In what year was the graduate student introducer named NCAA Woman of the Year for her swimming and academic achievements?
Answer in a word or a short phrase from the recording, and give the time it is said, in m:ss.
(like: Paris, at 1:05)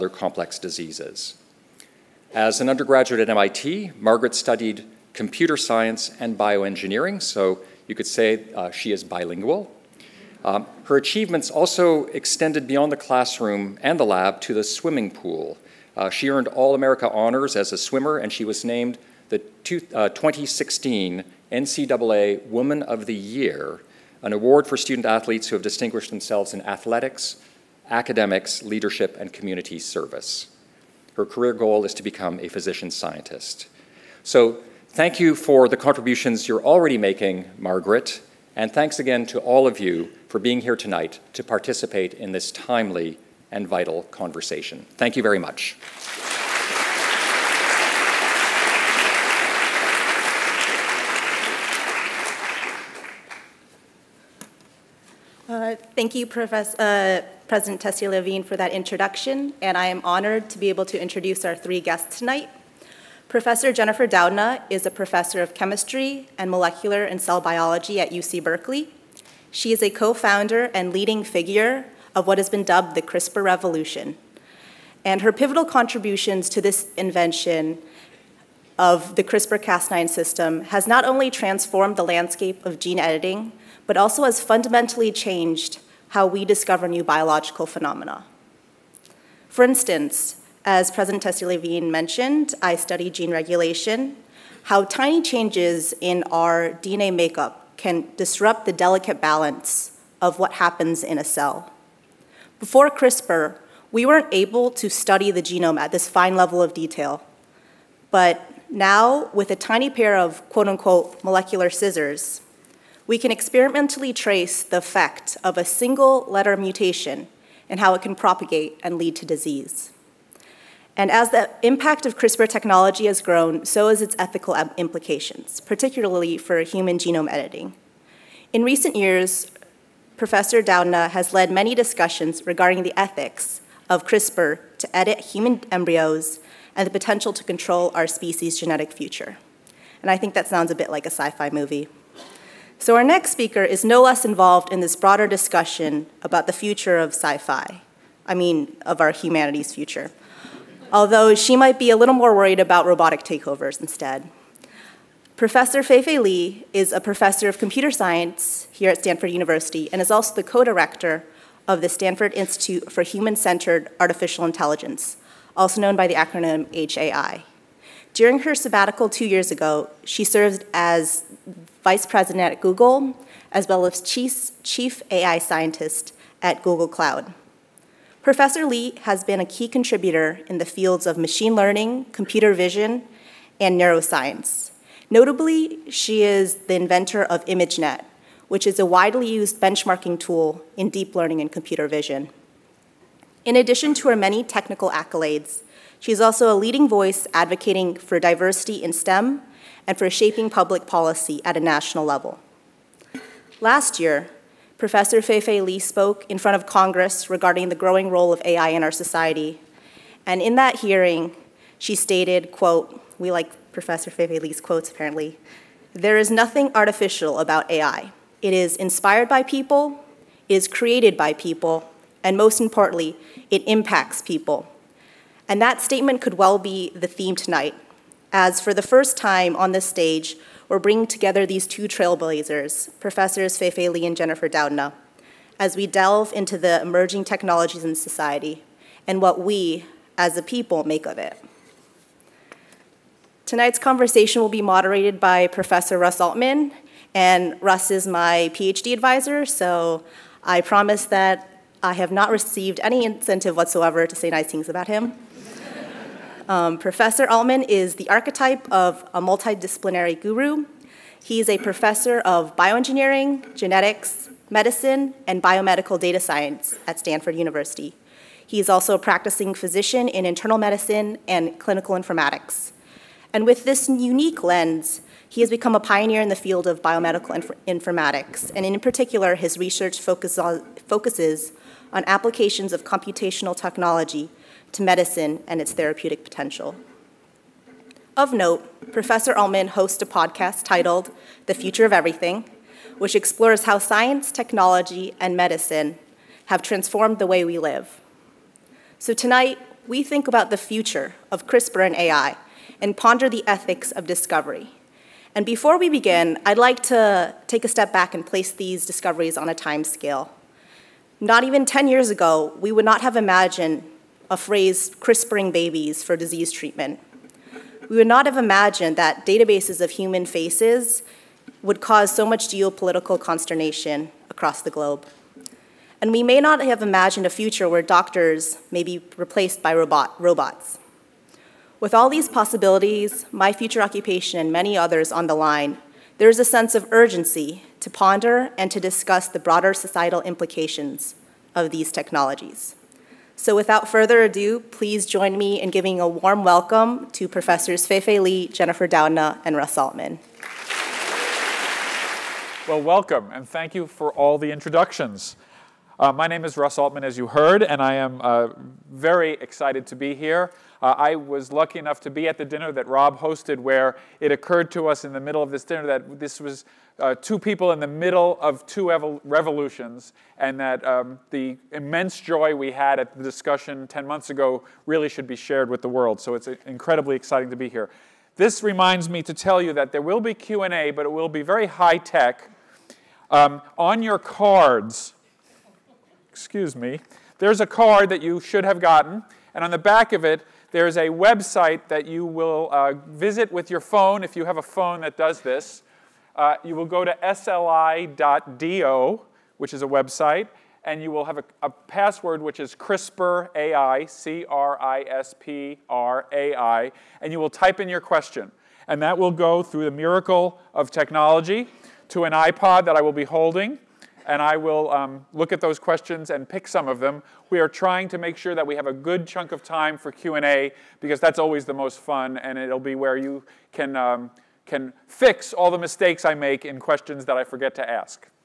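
2016, at 0:20.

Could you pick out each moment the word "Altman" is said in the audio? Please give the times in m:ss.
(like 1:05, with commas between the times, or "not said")
4:06, 4:17, 4:49, 5:49, 5:56.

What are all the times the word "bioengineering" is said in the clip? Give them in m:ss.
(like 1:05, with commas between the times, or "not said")
0:06, 4:22.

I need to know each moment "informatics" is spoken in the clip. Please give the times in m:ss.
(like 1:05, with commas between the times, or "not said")
4:31, 4:37.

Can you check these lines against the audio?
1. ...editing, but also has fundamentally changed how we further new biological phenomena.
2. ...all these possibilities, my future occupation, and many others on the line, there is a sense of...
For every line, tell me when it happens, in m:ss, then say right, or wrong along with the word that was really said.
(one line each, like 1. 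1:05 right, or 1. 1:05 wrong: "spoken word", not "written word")
1. 1:22 wrong: "discover", not "further"
2. 5:31 right.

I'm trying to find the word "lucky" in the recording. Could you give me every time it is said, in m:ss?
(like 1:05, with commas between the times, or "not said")
6:01.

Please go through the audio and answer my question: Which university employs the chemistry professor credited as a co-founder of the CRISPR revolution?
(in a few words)
UC Berkeley.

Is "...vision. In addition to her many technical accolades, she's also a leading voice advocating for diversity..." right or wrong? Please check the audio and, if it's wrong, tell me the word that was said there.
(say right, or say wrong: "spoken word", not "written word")
right.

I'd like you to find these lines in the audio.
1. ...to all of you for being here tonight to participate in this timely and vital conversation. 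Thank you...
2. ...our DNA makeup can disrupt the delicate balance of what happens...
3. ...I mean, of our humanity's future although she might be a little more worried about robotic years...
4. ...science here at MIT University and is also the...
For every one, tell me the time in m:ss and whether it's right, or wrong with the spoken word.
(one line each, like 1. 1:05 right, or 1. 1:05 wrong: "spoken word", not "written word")
1. 0:39 right
2. 1:36 right
3. 2:28 wrong: "takeovers", not "years"
4. 2:37 wrong: "Stanford", not "MIT".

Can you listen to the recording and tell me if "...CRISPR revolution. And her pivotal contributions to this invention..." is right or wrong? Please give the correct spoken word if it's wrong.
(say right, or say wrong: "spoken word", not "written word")
right.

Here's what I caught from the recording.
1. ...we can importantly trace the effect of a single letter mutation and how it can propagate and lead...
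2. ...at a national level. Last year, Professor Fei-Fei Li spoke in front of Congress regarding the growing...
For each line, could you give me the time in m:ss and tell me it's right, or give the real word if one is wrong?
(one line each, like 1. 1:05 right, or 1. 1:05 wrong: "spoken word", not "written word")
1. 1:53 wrong: "experimentally", not "importantly"
2. 3:21 right.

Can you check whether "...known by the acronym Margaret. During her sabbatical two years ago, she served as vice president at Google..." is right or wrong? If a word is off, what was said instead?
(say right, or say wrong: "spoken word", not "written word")
wrong: "HAI", not "Margaret".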